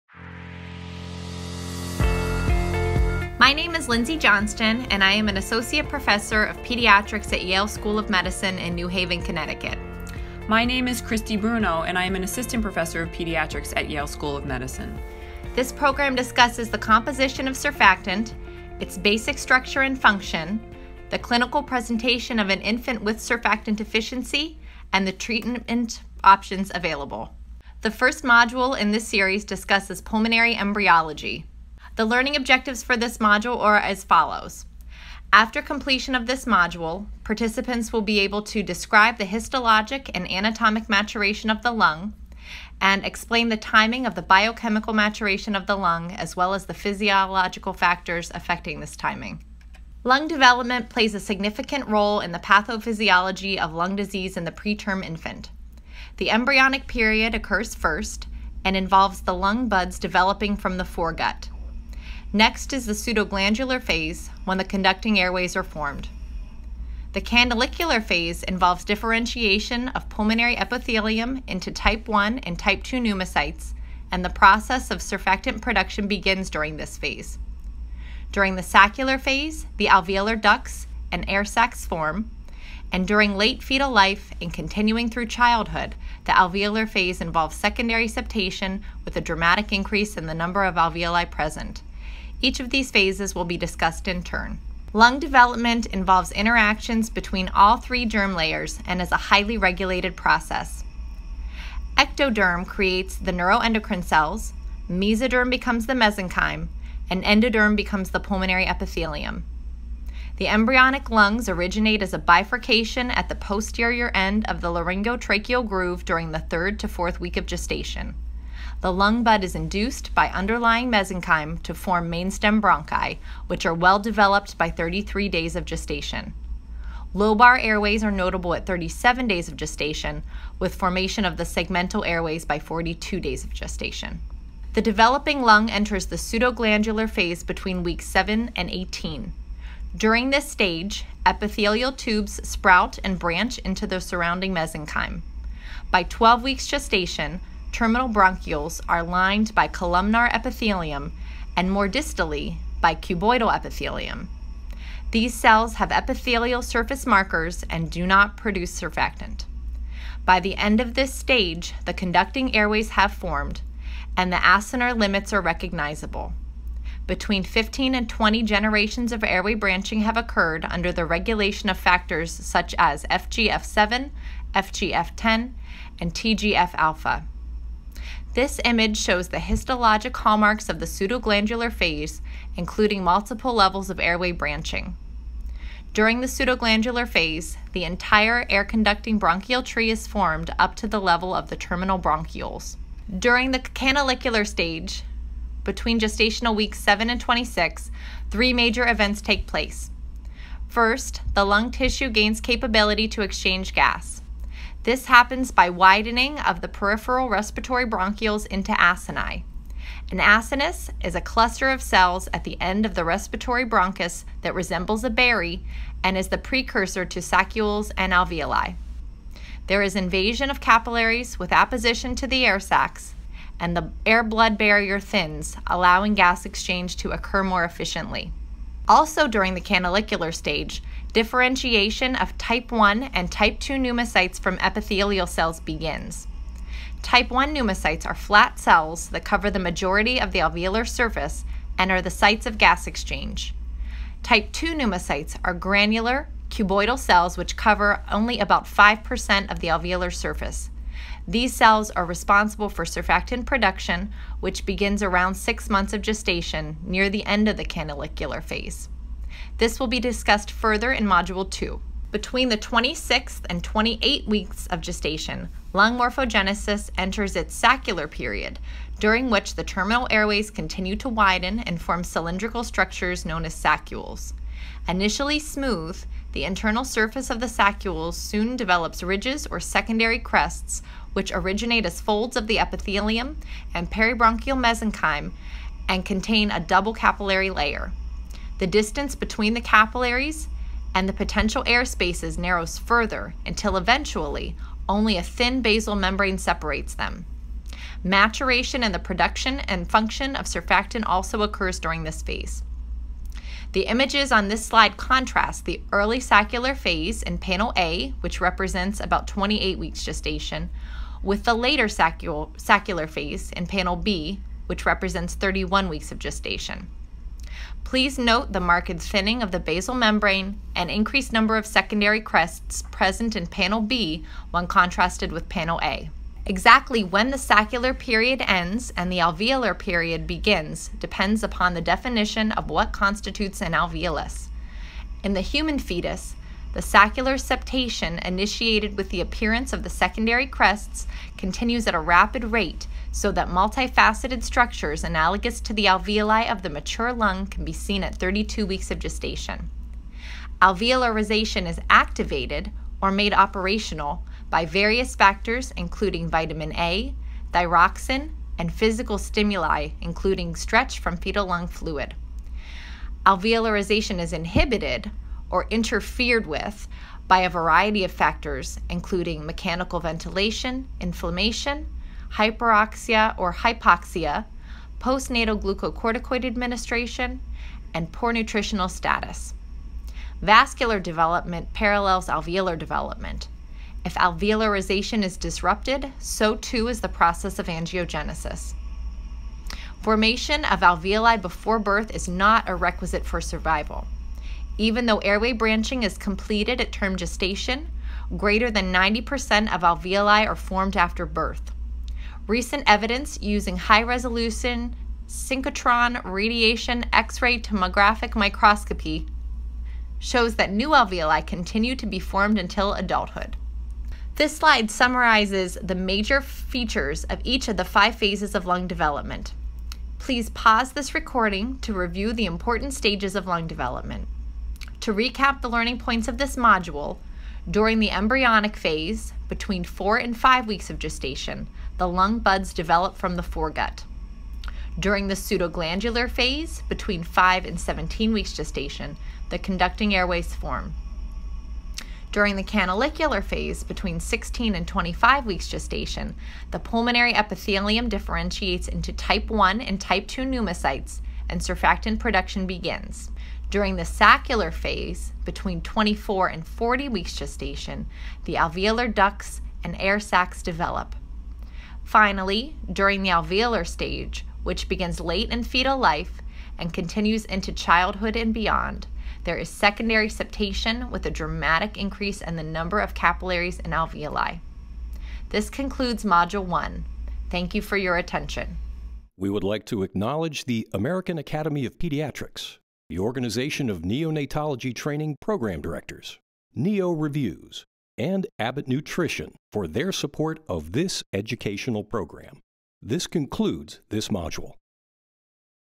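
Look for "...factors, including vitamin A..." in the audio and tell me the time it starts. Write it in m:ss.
5:55.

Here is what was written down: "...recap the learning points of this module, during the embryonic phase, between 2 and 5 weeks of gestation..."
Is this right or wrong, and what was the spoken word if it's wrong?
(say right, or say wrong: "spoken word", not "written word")
wrong: "4", not "2".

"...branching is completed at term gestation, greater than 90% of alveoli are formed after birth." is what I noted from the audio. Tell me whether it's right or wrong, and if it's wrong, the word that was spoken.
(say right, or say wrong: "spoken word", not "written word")
right.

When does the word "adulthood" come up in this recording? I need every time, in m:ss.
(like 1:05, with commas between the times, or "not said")
6:52.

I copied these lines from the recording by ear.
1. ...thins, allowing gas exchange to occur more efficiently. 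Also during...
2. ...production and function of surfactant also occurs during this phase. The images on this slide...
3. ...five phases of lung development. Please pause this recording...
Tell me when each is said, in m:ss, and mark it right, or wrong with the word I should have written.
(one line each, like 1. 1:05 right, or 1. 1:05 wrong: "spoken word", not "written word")
1. 3:44 right
2. 4:58 right
3. 6:57 right.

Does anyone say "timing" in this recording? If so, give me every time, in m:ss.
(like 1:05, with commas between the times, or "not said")
0:43, 0:48.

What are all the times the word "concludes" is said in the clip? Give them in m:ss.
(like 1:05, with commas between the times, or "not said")
7:55, 8:13.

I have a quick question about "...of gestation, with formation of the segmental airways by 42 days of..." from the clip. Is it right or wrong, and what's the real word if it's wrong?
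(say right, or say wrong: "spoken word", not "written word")
right.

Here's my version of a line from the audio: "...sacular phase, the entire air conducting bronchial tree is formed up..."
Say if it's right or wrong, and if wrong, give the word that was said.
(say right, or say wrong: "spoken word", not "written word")
wrong: "pseudoglandular", not "sacular".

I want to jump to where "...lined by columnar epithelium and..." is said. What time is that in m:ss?
2:29.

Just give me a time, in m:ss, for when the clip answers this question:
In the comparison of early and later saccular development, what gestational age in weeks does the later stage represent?
5:15.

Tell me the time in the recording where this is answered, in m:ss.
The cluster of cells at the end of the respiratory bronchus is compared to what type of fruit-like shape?
3:35.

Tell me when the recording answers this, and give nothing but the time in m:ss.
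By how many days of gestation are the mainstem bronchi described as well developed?
2:04.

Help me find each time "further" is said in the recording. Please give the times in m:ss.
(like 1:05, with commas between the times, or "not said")
4:20, 4:52.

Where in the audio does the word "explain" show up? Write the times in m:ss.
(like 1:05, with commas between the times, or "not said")
0:43.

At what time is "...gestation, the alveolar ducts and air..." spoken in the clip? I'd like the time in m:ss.
7:37.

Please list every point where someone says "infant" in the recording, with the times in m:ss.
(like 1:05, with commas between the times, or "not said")
0:22, 0:55.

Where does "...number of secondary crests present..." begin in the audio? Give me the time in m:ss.
5:21.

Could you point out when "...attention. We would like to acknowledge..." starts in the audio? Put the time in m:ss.
7:58.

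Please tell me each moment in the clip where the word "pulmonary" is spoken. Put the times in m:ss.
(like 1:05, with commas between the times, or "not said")
0:29, 1:10, 1:48, 7:26.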